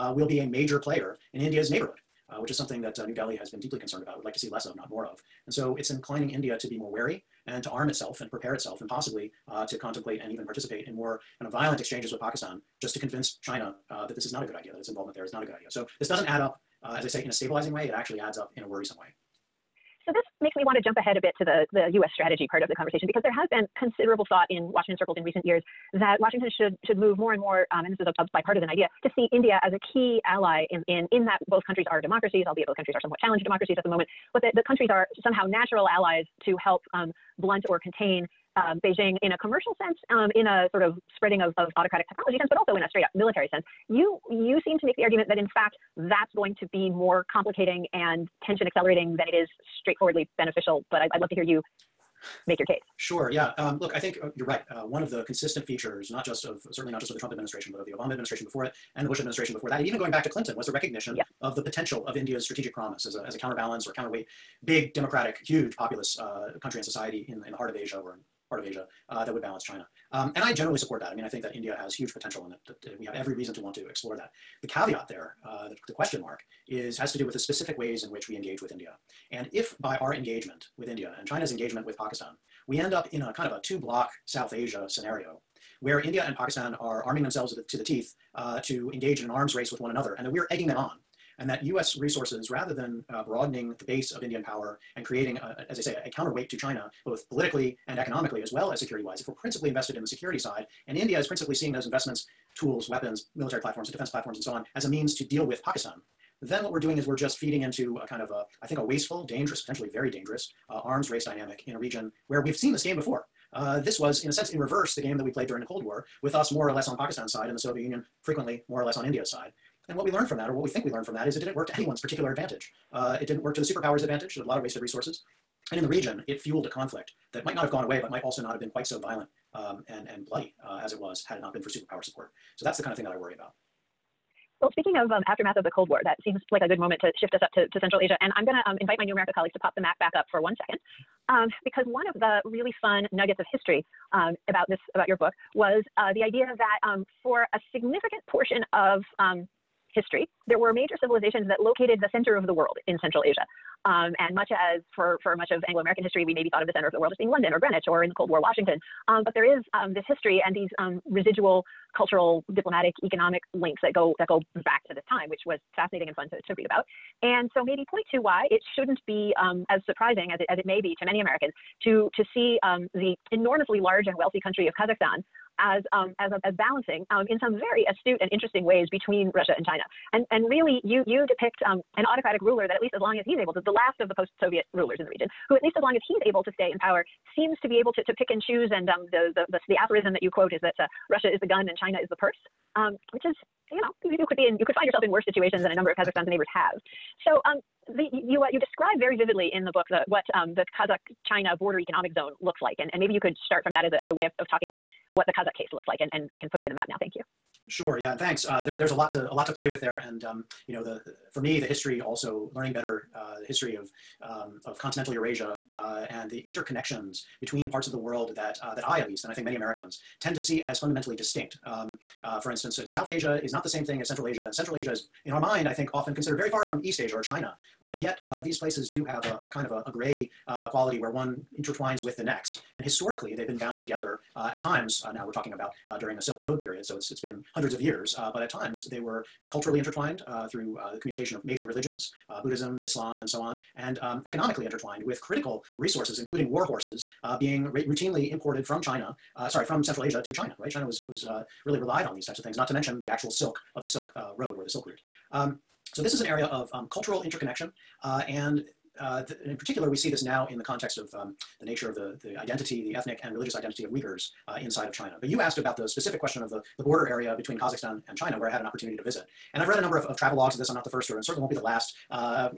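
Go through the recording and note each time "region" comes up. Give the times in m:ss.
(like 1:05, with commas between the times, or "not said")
1:51, 2:05, 3:05.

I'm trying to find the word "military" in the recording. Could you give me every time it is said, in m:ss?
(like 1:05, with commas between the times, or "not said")
0:43, 1:43.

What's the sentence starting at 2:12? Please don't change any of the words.
So that's the kind of thing that I worry about.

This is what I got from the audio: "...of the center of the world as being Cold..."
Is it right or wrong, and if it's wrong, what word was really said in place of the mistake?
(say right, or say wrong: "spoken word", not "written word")
wrong: "London", not "Cold".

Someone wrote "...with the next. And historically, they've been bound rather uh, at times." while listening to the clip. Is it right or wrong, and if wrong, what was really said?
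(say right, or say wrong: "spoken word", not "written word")
wrong: "together", not "rather".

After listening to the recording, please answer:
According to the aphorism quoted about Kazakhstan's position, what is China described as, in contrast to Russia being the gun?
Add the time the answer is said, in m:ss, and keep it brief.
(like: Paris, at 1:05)
the purse, at 3:12.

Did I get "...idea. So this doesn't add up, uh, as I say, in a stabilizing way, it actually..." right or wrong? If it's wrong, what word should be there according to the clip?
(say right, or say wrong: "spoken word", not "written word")
right.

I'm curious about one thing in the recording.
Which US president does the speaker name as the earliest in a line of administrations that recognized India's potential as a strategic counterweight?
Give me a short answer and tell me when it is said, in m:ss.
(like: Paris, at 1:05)
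Clinton, at 1:00.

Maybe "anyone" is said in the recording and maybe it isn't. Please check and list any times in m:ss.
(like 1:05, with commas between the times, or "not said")
2:01.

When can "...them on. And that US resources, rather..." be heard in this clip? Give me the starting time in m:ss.
1:30.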